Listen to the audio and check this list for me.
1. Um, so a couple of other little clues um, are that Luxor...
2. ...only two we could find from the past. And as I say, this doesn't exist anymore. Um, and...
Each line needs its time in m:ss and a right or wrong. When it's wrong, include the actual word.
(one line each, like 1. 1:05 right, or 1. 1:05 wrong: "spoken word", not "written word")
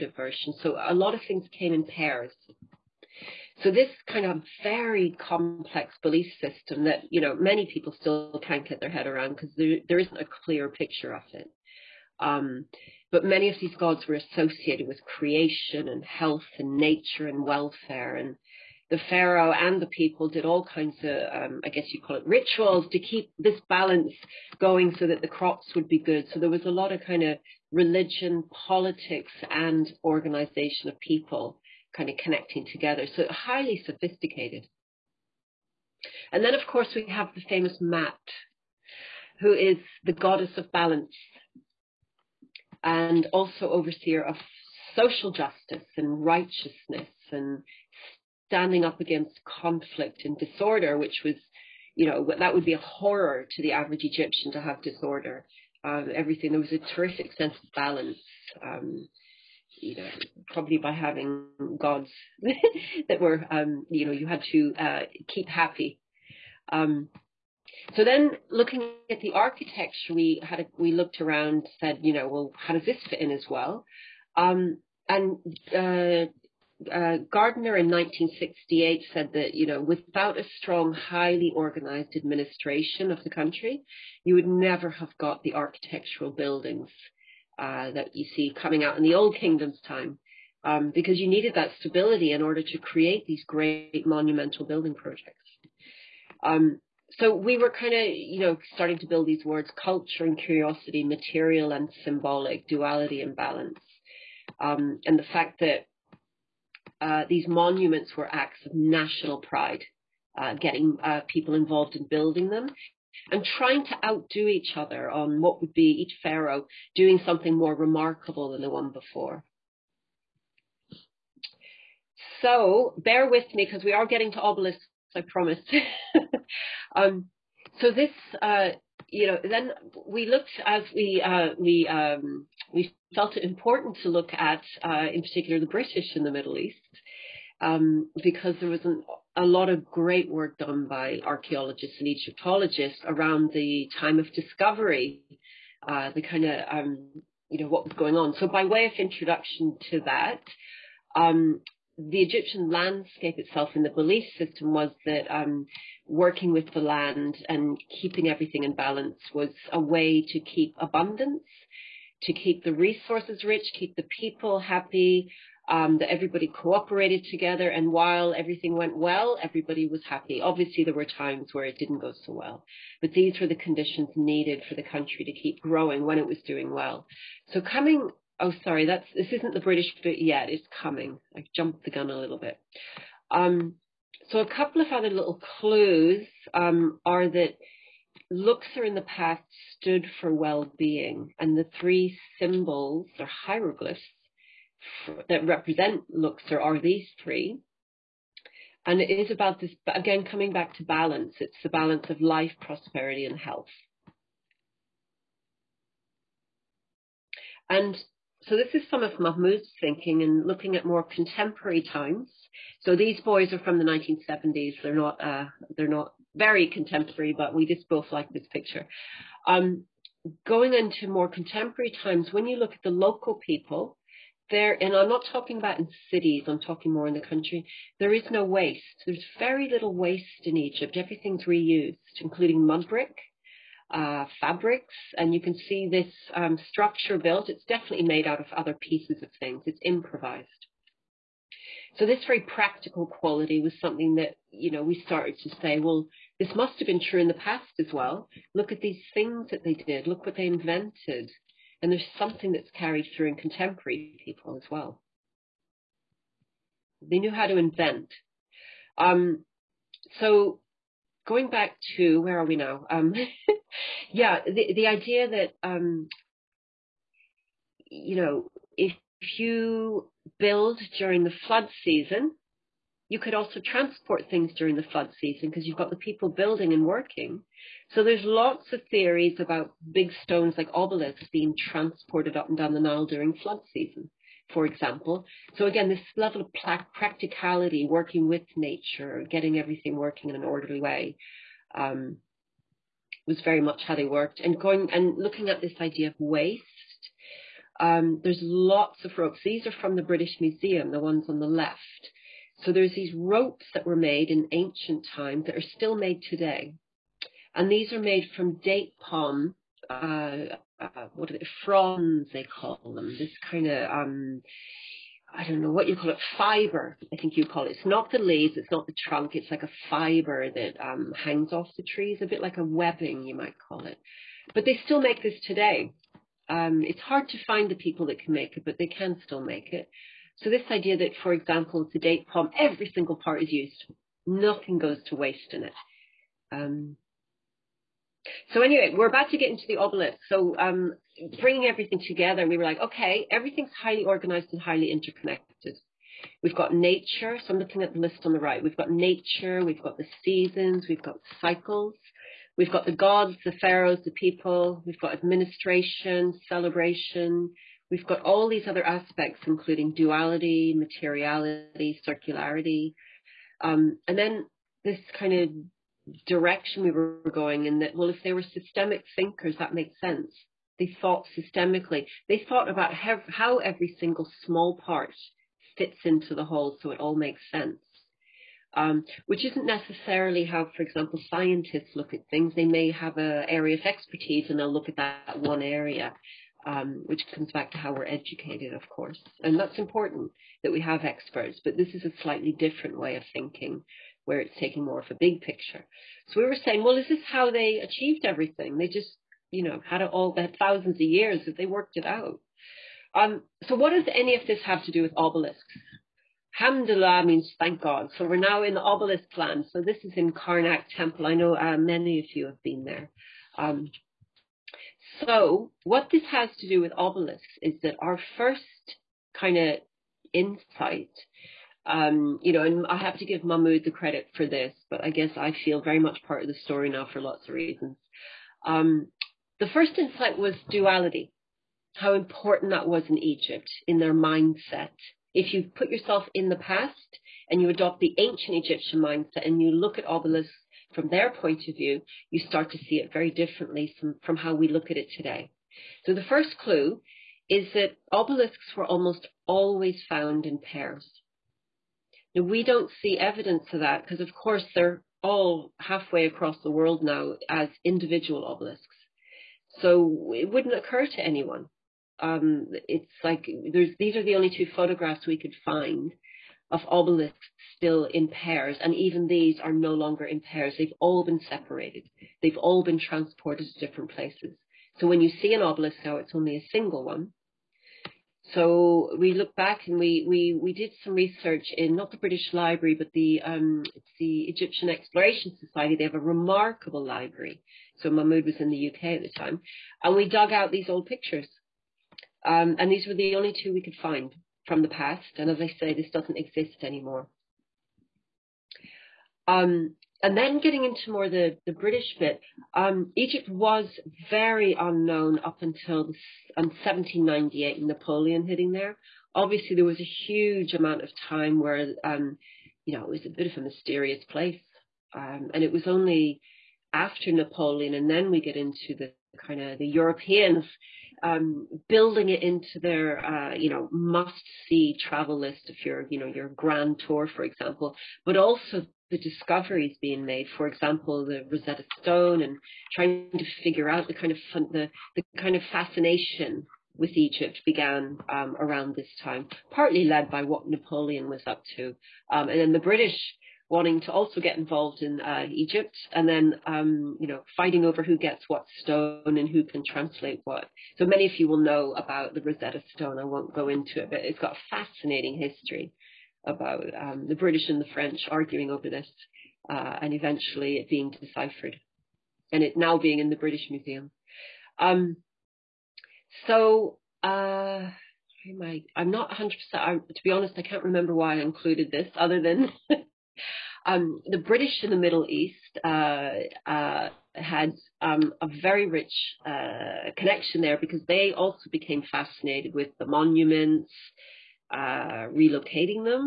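1. 3:03 right
2. 8:13 right.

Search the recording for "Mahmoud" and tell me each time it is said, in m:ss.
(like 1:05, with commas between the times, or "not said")
3:29, 7:03, 8:08.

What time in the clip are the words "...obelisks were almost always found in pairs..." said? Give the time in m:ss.
7:28.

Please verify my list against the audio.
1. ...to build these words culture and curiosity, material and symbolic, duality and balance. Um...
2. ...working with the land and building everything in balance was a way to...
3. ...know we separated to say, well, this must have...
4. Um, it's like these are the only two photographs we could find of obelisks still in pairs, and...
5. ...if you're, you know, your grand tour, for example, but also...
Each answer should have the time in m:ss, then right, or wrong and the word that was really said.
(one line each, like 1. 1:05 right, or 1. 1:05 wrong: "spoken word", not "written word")
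1. 1:38 right
2. 2:36 wrong: "keeping", not "building"
3. 4:04 wrong: "started", not "separated"
4. 7:42 right
5. 8:45 right.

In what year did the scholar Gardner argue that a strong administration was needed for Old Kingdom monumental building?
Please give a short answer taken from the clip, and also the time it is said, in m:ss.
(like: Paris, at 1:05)
1968, at 1:17.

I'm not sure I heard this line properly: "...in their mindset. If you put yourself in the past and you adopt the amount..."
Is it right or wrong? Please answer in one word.
wrong.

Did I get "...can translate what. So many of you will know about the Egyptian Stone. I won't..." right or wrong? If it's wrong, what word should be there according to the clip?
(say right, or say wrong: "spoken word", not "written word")
wrong: "Rosetta", not "Egyptian".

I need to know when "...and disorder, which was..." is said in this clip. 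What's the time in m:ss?
0:50.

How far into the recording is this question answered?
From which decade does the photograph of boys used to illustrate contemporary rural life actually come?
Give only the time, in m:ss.
3:33.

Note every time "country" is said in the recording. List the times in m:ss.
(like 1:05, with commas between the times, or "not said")
1:23, 2:54, 3:47.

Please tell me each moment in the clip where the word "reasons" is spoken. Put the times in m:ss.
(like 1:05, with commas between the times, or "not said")
7:07.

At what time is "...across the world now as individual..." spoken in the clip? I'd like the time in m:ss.
7:36.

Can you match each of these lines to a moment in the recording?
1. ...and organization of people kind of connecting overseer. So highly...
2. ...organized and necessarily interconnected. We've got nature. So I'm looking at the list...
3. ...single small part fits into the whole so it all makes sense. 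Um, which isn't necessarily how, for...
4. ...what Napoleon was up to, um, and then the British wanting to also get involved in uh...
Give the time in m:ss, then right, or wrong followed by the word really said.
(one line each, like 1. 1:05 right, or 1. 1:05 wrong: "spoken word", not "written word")
1. 0:29 wrong: "together", not "overseer"
2. 5:44 wrong: "highly", not "necessarily"
3. 6:13 right
4. 9:00 right.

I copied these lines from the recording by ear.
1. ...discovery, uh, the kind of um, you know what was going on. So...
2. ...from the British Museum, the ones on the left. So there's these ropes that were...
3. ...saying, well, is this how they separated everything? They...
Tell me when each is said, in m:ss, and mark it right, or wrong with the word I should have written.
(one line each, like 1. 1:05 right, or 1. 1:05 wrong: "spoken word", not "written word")
1. 2:24 right
2. 4:59 right
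3. 6:36 wrong: "achieved", not "separated".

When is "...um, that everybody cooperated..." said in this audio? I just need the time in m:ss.
2:45.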